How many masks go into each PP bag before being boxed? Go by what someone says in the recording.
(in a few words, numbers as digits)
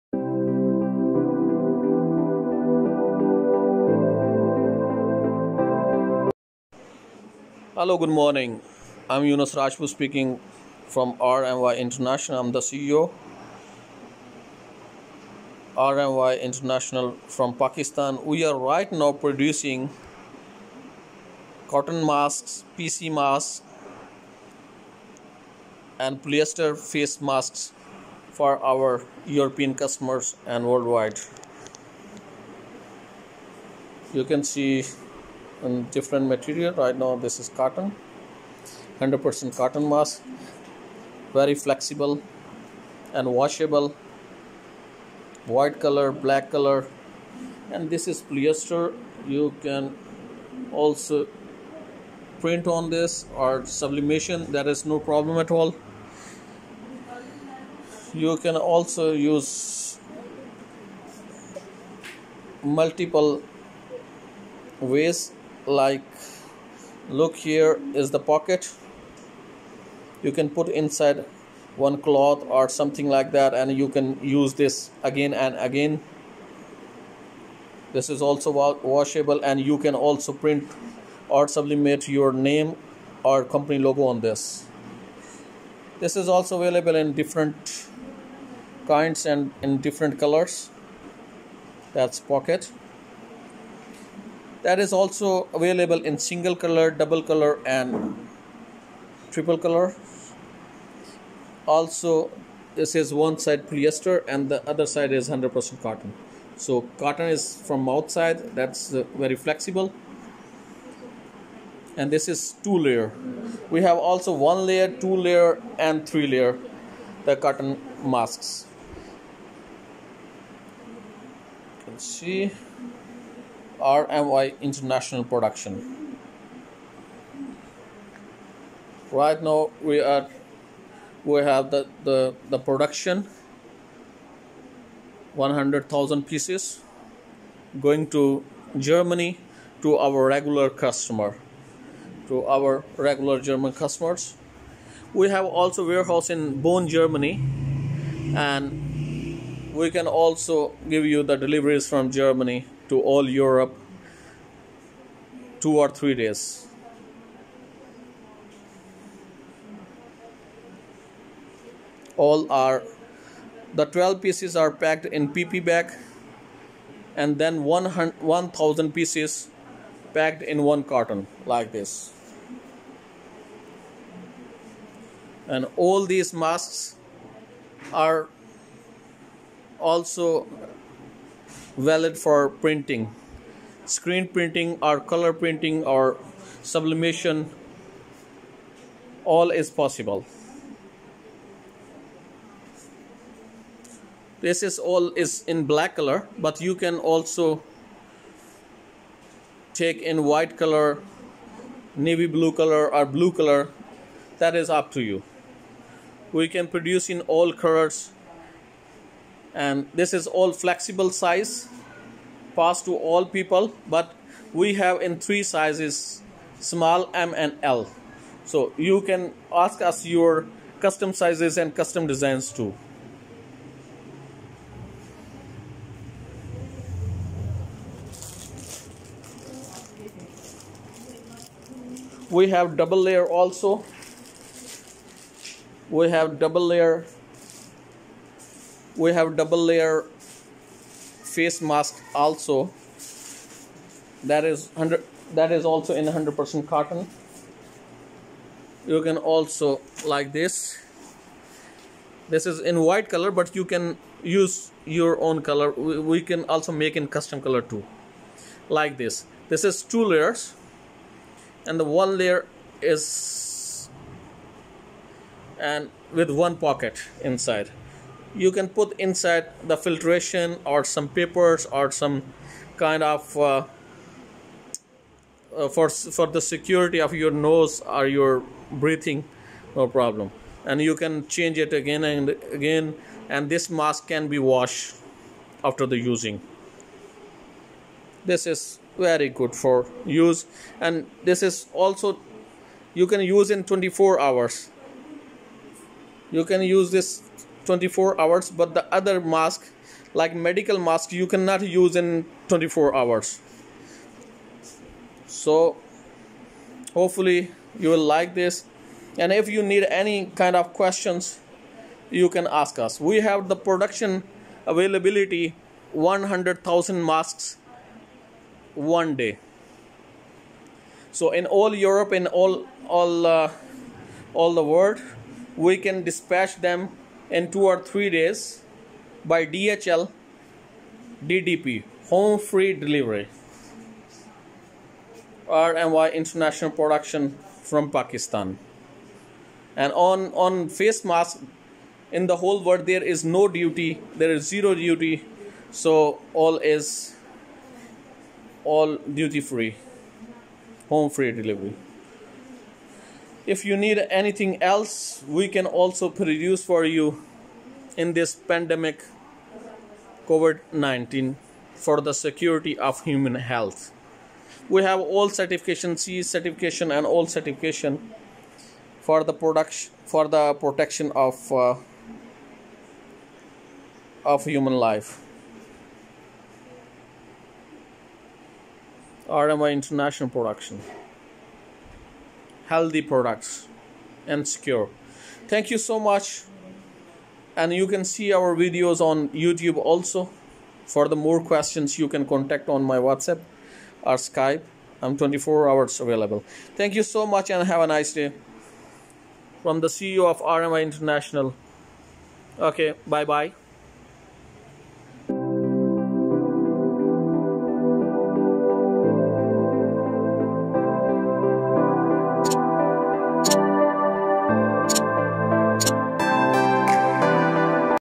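12.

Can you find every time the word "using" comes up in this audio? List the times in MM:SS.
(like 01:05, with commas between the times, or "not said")
04:45.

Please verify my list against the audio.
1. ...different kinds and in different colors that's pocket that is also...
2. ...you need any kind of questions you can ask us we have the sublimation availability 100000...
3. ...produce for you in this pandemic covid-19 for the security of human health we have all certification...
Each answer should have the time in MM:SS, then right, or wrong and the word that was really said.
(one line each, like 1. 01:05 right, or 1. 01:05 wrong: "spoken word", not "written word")
1. 01:27 right
2. 05:09 wrong: "production", not "sublimation"
3. 05:56 right.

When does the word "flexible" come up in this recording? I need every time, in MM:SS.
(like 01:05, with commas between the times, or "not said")
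00:41, 01:49, 03:30.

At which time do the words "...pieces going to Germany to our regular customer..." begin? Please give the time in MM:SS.
02:16.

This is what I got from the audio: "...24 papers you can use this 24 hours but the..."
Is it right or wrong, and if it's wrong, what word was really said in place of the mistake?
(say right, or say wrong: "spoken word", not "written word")
wrong: "hours", not "papers".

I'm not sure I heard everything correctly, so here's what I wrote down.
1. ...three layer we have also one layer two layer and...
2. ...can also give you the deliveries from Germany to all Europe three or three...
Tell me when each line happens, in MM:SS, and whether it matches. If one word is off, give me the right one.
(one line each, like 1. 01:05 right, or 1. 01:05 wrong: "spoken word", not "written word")
1. 01:52 wrong: "two", not "three"
2. 02:29 wrong: "two", not "three".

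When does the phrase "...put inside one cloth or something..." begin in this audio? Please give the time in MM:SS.
01:10.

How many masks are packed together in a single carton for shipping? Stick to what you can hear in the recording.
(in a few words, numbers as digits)
1000.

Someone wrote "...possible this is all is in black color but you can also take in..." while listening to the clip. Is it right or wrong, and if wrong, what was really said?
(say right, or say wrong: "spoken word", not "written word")
right.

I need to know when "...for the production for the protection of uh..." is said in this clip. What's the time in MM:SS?
06:08.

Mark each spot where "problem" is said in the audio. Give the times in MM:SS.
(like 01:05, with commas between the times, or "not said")
00:55, 04:39.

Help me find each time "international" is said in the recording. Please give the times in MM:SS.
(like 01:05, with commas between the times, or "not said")
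00:11, 00:16, 02:04, 05:36, 06:19, 06:40.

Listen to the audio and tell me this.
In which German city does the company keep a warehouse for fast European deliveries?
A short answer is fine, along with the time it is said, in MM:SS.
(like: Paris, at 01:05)
Bonn, at 02:26.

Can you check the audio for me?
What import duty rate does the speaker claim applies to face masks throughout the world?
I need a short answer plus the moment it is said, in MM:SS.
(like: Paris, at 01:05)
zero duty, at 05:44.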